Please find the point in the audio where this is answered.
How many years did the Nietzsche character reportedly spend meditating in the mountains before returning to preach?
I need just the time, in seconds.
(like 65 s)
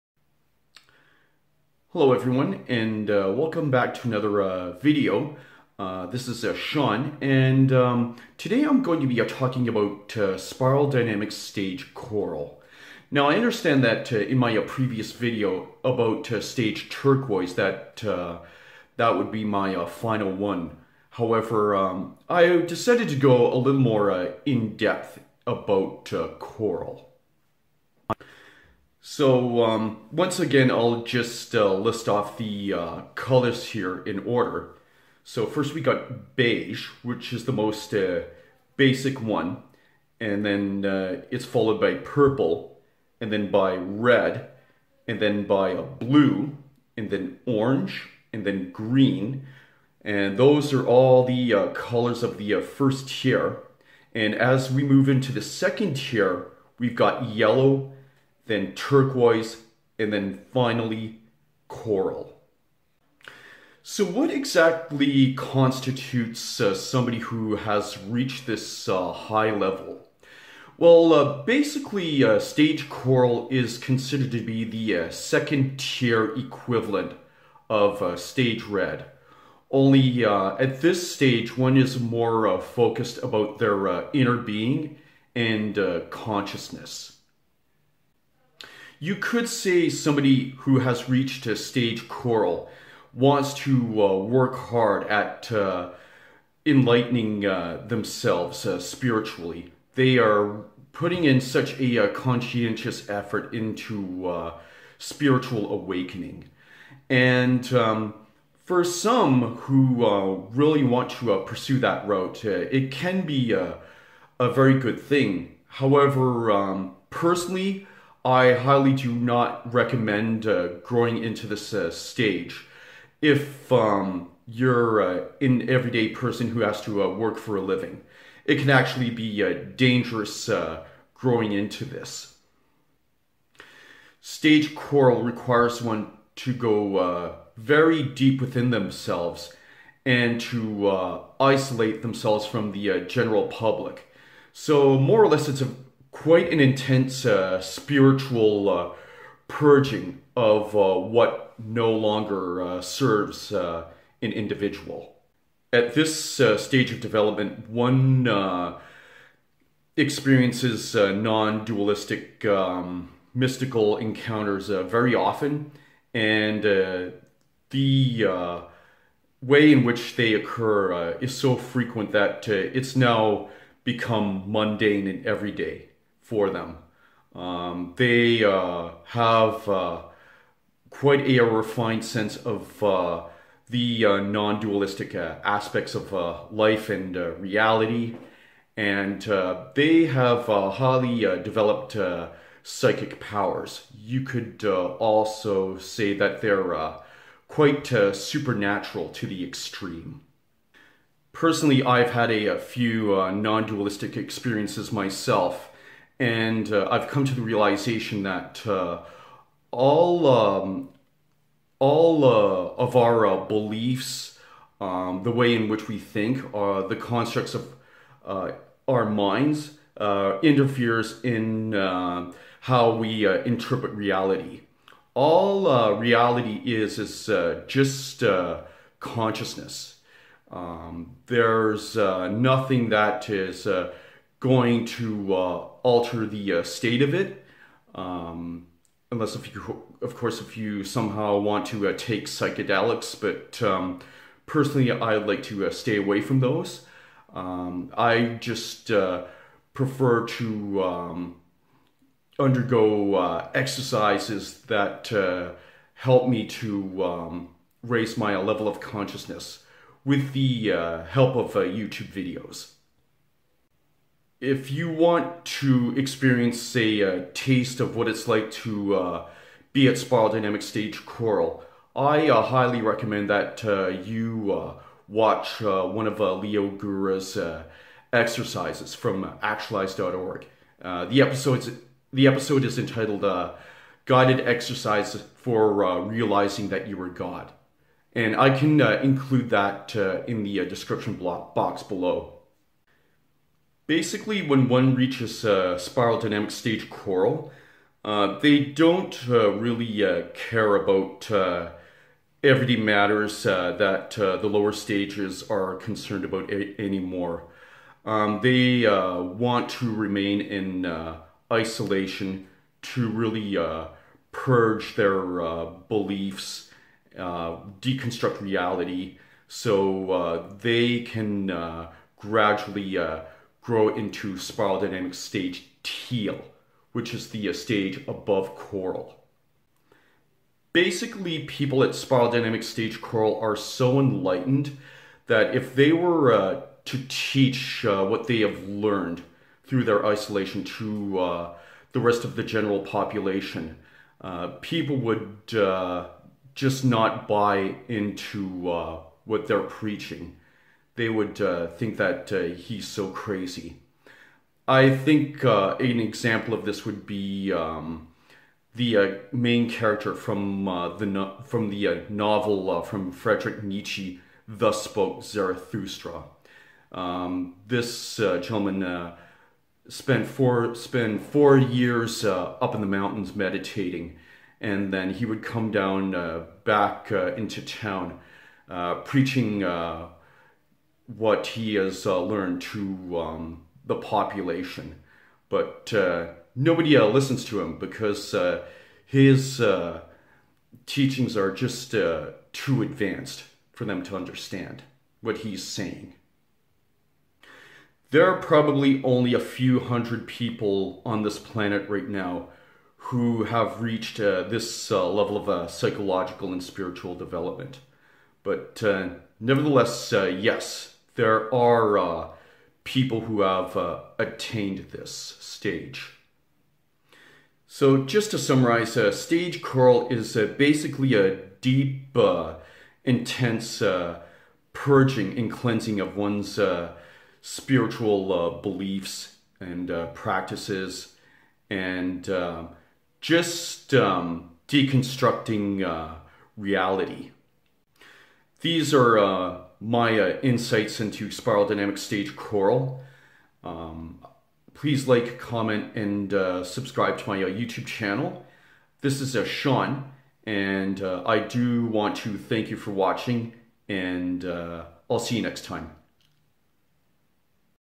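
371 s.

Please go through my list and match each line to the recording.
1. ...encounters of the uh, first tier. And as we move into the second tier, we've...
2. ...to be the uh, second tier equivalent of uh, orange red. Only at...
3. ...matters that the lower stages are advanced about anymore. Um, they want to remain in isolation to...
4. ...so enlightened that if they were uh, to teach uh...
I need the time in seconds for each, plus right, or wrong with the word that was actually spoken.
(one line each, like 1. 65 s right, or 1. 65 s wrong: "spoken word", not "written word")
1. 51 s wrong: "colors", not "encounters"
2. 74 s wrong: "stage", not "orange"
3. 302 s wrong: "concerned", not "advanced"
4. 333 s right.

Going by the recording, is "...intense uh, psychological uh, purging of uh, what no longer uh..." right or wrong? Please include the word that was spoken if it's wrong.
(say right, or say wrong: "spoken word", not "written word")
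wrong: "spiritual", not "psychological".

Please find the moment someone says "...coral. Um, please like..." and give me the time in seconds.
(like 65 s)
442 s.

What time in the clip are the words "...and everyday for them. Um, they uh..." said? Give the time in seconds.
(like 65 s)
175 s.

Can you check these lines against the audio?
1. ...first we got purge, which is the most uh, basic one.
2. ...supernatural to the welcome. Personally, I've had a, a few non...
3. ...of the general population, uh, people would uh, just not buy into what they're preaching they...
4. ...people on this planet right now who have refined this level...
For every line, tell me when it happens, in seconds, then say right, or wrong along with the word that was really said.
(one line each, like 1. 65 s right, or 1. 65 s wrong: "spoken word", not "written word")
1. 35 s wrong: "beige", not "purge"
2. 198 s wrong: "extreme", not "welcome"
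3. 342 s right
4. 400 s wrong: "reached", not "refined".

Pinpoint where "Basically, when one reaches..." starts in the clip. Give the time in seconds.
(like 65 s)
293 s.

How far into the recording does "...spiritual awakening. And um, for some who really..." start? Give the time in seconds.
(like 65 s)
104 s.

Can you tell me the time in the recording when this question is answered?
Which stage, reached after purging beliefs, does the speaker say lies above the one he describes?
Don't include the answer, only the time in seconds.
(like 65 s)
325 s.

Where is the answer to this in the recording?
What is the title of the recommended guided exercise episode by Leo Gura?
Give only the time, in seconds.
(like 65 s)
284 s.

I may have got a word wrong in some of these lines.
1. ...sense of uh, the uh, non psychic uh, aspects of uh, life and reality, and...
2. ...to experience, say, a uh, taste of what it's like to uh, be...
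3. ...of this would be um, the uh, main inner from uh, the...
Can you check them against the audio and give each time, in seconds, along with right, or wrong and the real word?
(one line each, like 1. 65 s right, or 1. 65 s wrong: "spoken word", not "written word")
1. 182 s wrong: "dualistic", not "psychic"
2. 265 s right
3. 356 s wrong: "character", not "inner".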